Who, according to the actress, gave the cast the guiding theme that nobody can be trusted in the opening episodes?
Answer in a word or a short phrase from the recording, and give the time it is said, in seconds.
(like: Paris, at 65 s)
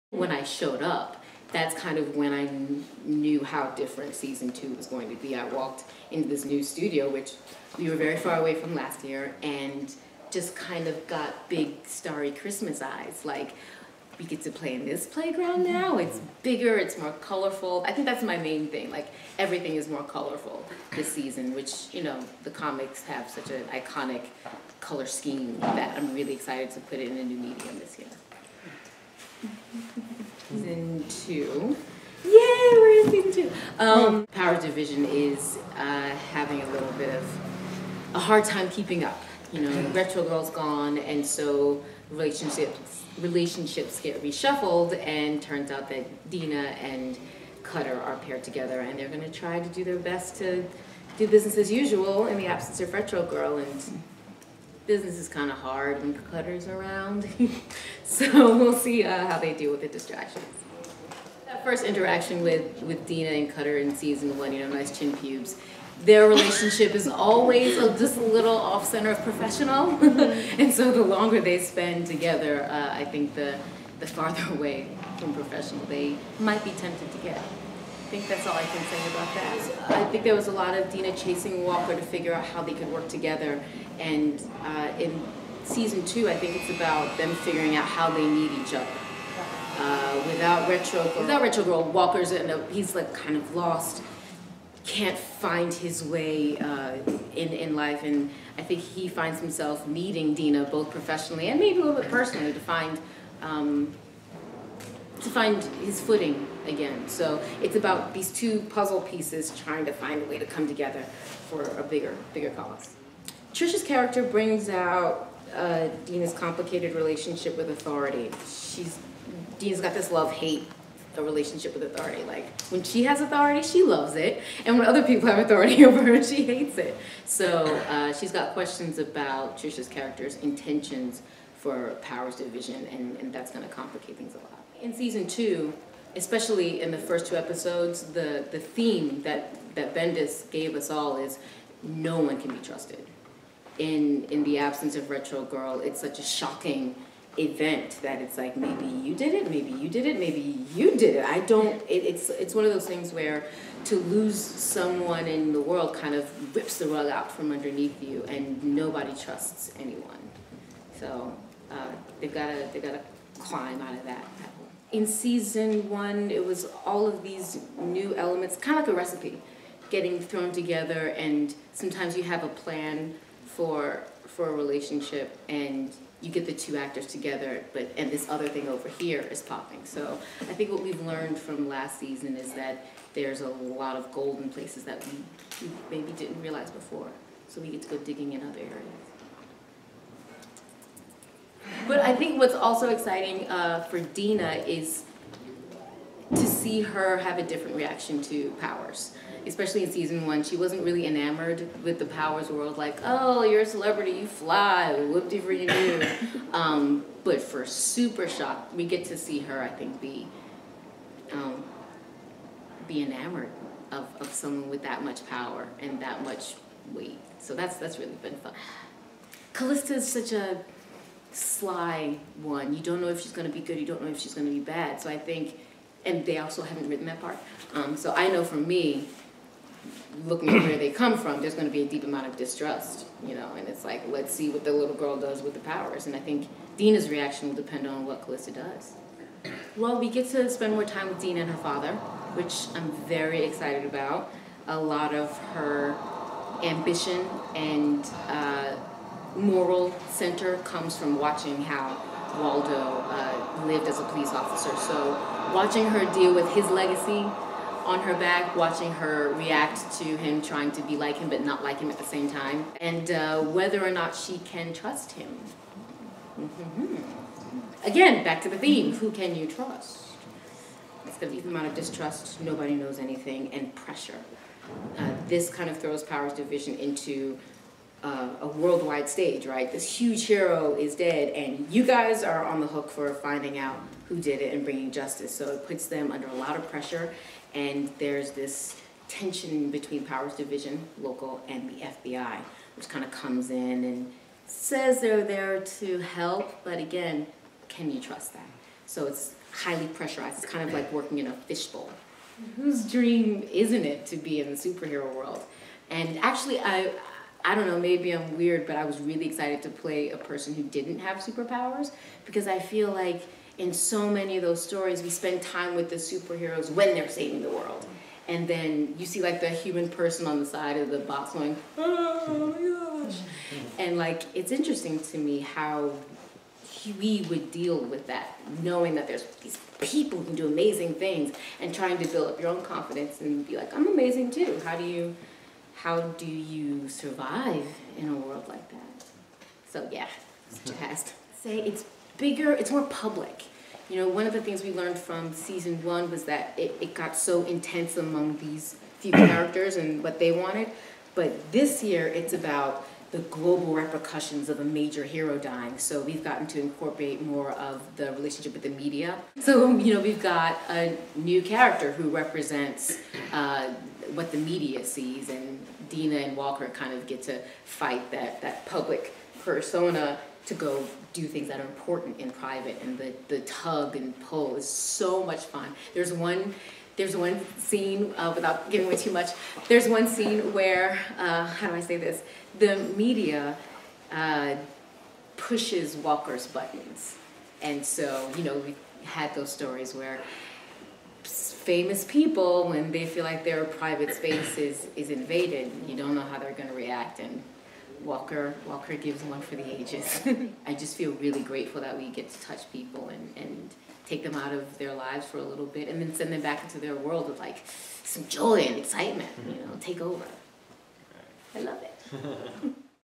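Bendis, at 139 s.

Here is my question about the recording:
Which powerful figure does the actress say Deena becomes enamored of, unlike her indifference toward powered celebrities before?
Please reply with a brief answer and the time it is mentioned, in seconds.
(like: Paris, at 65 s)
Super Shock, at 207 s.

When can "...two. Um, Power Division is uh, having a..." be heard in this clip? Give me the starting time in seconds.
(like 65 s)
33 s.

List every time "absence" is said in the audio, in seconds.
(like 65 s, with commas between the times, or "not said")
52 s, 144 s.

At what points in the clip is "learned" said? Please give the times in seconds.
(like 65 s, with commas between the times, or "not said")
181 s, 344 s.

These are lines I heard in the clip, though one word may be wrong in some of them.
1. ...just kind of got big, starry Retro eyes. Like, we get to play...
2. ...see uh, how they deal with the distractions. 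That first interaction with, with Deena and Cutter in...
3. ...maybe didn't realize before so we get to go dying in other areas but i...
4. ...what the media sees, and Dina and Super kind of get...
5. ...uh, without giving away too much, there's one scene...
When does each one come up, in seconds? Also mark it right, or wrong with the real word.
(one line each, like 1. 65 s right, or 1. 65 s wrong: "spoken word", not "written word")
1. 10 s wrong: "Christmas", not "Retro"
2. 58 s right
3. 185 s wrong: "digging", not "dying"
4. 364 s wrong: "Walker", not "Super"
5. 378 s right.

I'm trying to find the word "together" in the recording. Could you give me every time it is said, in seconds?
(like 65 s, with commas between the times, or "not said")
48 s, 72 s, 83 s, 110 s, 170 s, 177 s.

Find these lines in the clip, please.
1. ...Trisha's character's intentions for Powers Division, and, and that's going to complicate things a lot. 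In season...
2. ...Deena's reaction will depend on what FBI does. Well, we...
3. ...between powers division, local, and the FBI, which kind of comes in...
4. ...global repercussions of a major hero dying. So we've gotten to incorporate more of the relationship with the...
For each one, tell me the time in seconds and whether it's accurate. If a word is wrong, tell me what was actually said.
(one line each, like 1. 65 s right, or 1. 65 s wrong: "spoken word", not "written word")
1. 129 s right
2. 236 s wrong: "Calista", not "FBI"
3. 289 s right
4. 353 s right.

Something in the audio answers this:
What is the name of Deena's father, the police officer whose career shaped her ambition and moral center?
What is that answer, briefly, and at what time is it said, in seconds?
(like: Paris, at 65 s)
Waldo, at 252 s.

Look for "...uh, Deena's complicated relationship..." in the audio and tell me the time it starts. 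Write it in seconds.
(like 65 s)
115 s.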